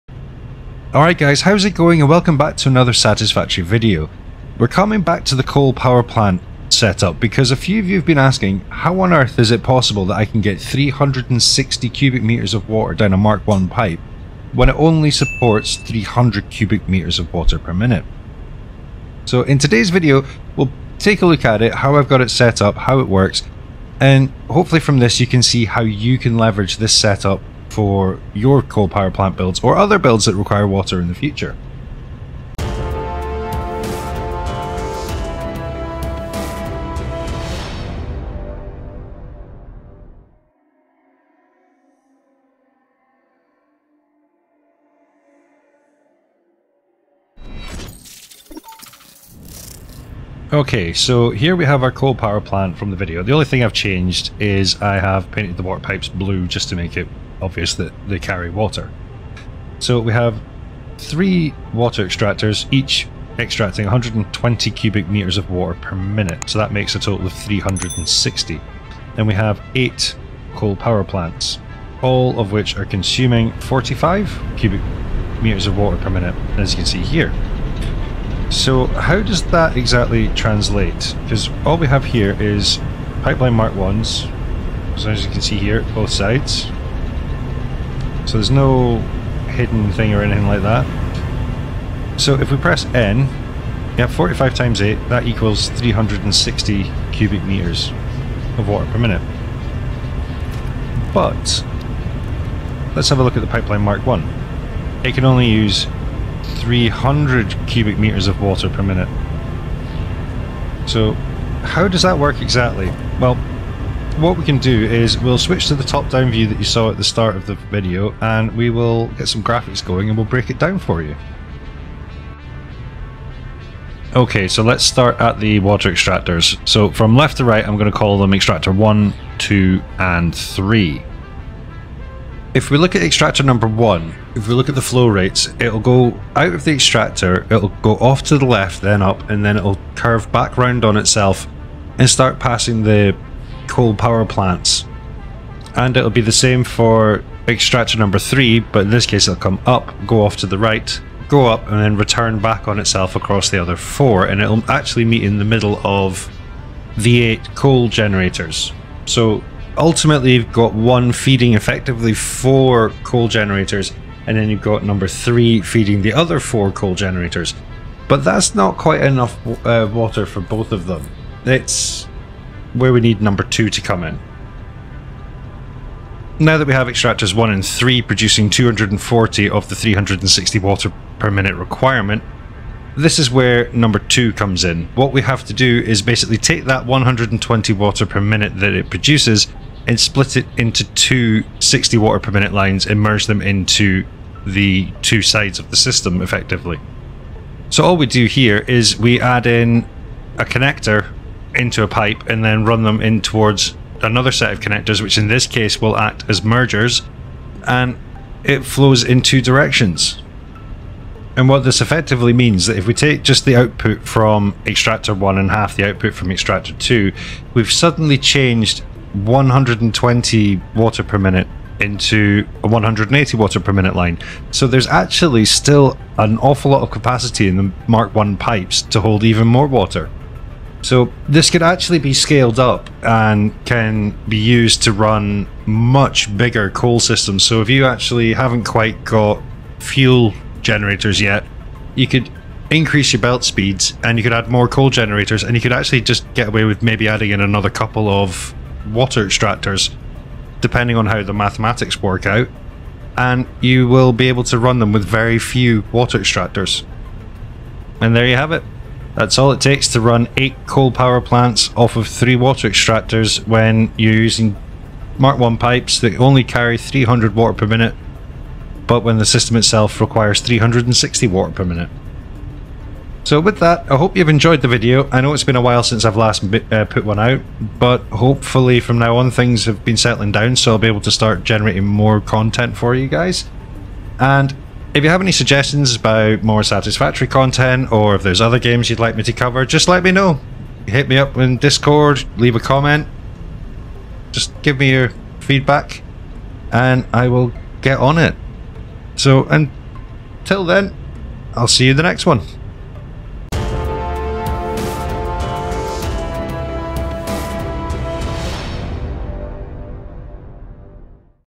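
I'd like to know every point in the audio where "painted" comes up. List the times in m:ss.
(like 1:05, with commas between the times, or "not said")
0:55.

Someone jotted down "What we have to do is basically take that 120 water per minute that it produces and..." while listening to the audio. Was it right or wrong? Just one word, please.
right.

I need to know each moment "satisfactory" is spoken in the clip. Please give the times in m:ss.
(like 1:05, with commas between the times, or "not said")
0:02, 4:46.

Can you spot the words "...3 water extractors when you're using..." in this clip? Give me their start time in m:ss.
4:22.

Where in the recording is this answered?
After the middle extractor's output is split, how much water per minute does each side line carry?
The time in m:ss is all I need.
3:42.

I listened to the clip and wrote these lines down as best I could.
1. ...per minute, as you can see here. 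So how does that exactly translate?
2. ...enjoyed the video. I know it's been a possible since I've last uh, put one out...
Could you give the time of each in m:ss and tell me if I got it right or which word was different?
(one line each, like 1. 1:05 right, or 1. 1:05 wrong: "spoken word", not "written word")
1. 1:15 right
2. 4:34 wrong: "while", not "possible".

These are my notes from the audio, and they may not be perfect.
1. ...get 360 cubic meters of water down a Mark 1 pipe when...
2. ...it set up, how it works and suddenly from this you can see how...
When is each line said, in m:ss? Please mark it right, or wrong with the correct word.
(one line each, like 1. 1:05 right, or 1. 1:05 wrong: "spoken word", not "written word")
1. 0:10 right
2. 0:22 wrong: "hopefully", not "suddenly".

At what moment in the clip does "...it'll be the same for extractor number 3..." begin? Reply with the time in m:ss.
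2:25.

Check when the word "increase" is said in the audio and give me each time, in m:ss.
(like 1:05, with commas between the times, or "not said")
4:02.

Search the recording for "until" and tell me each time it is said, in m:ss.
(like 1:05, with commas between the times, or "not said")
4:59.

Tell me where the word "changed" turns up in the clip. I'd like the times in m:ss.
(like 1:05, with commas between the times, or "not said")
0:53, 3:38.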